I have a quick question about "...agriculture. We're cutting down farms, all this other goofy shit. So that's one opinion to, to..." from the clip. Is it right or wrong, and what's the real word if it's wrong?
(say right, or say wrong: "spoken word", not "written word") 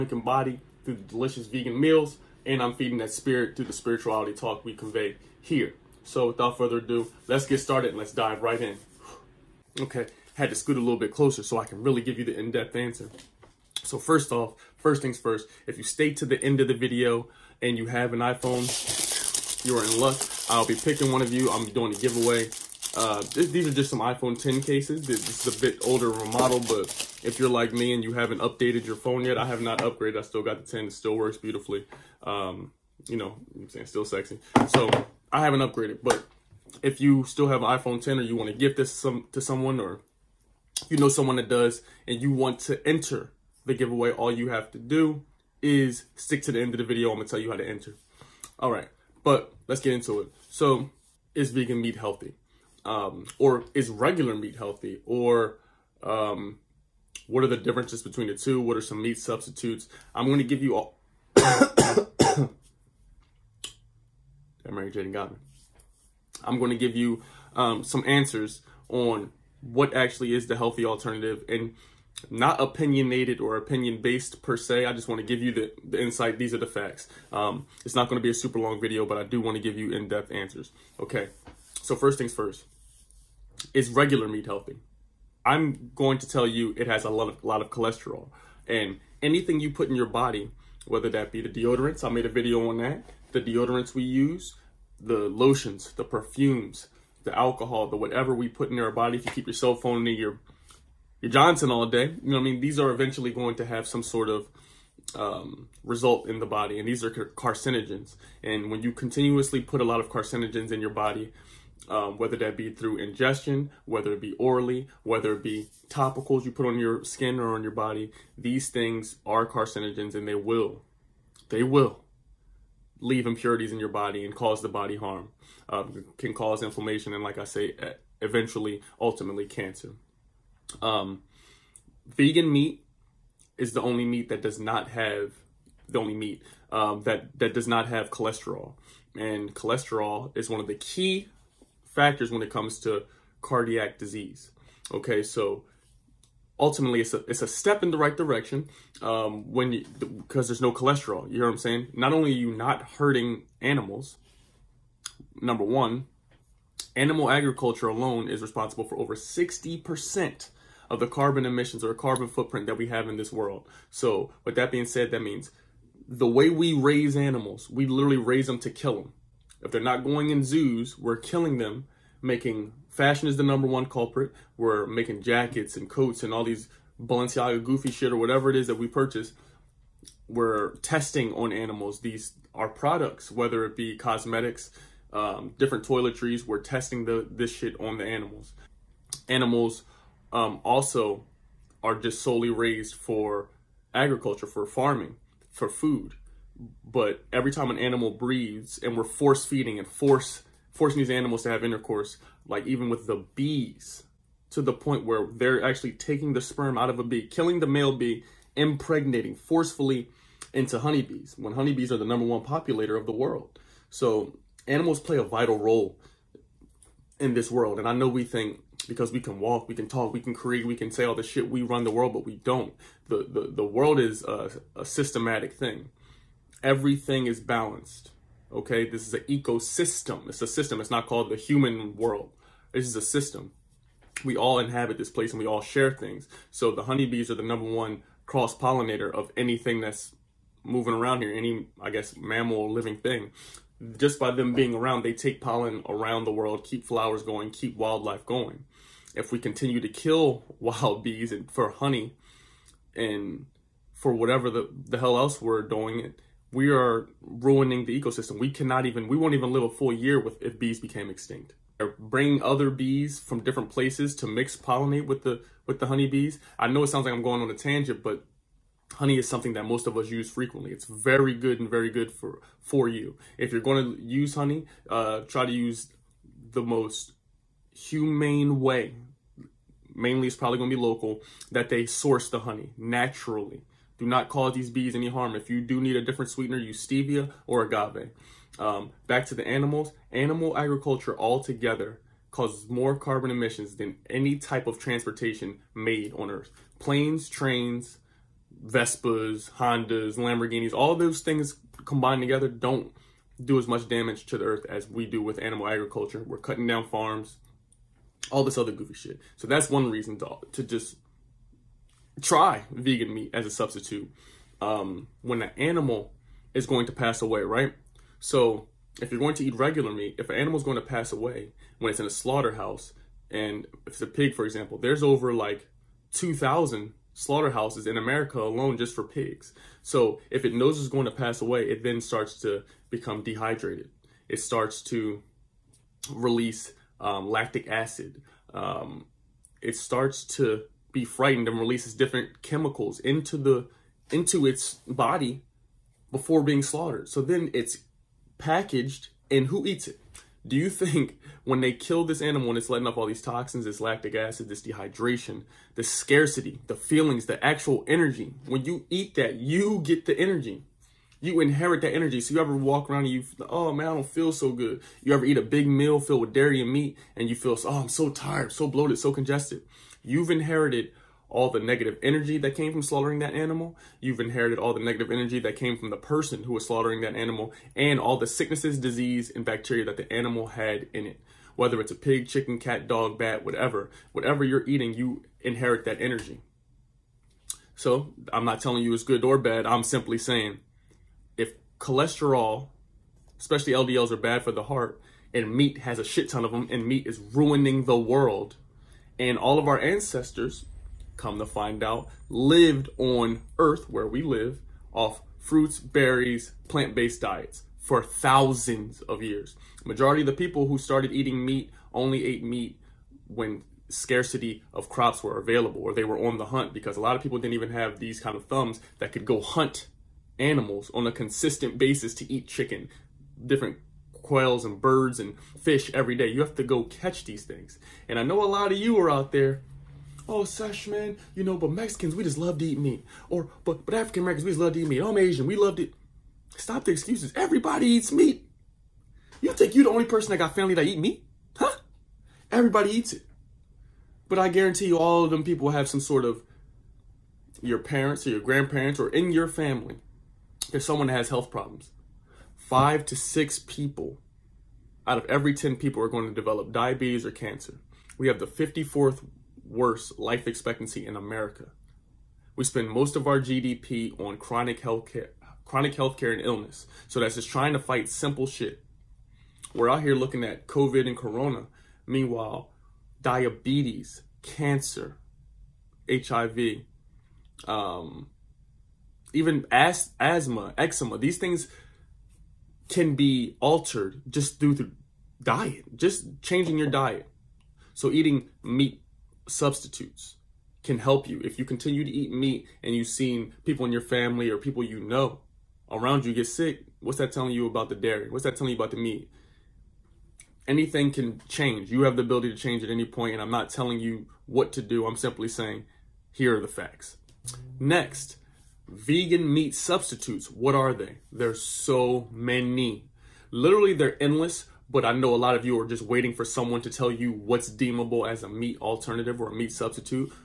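wrong: "reason", not "opinion".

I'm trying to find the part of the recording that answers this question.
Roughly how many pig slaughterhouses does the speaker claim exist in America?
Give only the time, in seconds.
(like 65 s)
325 s.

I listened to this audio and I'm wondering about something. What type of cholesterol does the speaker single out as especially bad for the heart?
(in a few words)
LDLs.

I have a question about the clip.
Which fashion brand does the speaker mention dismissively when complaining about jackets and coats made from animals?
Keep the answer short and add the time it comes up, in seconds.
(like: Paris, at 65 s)
Balenciaga, at 177 s.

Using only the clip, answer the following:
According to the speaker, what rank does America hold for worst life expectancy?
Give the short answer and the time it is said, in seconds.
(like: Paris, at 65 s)
54th, at 458 s.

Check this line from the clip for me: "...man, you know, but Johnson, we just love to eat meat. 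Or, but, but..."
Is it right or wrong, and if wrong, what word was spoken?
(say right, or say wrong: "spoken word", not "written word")
wrong: "Mexicans", not "Johnson".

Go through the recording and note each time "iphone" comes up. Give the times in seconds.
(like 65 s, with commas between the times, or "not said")
18 s, 23 s, 37 s.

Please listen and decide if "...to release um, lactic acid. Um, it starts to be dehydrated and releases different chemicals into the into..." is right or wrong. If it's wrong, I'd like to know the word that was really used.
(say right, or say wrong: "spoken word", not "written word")
wrong: "frightened", not "dehydrated".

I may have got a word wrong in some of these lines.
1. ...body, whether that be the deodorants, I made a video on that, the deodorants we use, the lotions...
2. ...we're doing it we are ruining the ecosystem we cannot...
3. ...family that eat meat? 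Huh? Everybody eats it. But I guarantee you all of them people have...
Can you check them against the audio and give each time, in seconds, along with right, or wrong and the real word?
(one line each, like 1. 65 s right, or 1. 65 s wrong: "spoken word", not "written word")
1. 90 s right
2. 255 s right
3. 440 s right.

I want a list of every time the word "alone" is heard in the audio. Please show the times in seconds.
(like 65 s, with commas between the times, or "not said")
157 s, 328 s.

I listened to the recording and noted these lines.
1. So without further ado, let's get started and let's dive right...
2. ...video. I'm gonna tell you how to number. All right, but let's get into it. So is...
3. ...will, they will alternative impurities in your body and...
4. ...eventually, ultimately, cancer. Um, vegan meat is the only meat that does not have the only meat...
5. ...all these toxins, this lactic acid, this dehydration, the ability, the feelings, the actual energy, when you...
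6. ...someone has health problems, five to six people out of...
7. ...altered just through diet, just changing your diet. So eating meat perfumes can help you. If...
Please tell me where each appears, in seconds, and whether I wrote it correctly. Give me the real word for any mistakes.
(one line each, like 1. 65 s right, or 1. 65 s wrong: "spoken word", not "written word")
1. 6 s right
2. 46 s wrong: "enter", not "number"
3. 120 s wrong: "leave", not "alternative"
4. 128 s right
5. 352 s wrong: "scarcity", not "ability"
6. 450 s right
7. 483 s wrong: "substitutes", not "perfumes".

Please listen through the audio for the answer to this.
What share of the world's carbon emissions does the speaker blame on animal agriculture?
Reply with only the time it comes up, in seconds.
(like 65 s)
158 s.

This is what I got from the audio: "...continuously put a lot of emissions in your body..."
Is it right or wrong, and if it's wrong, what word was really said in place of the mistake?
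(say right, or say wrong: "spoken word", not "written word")
wrong: "carcinogens", not "emissions".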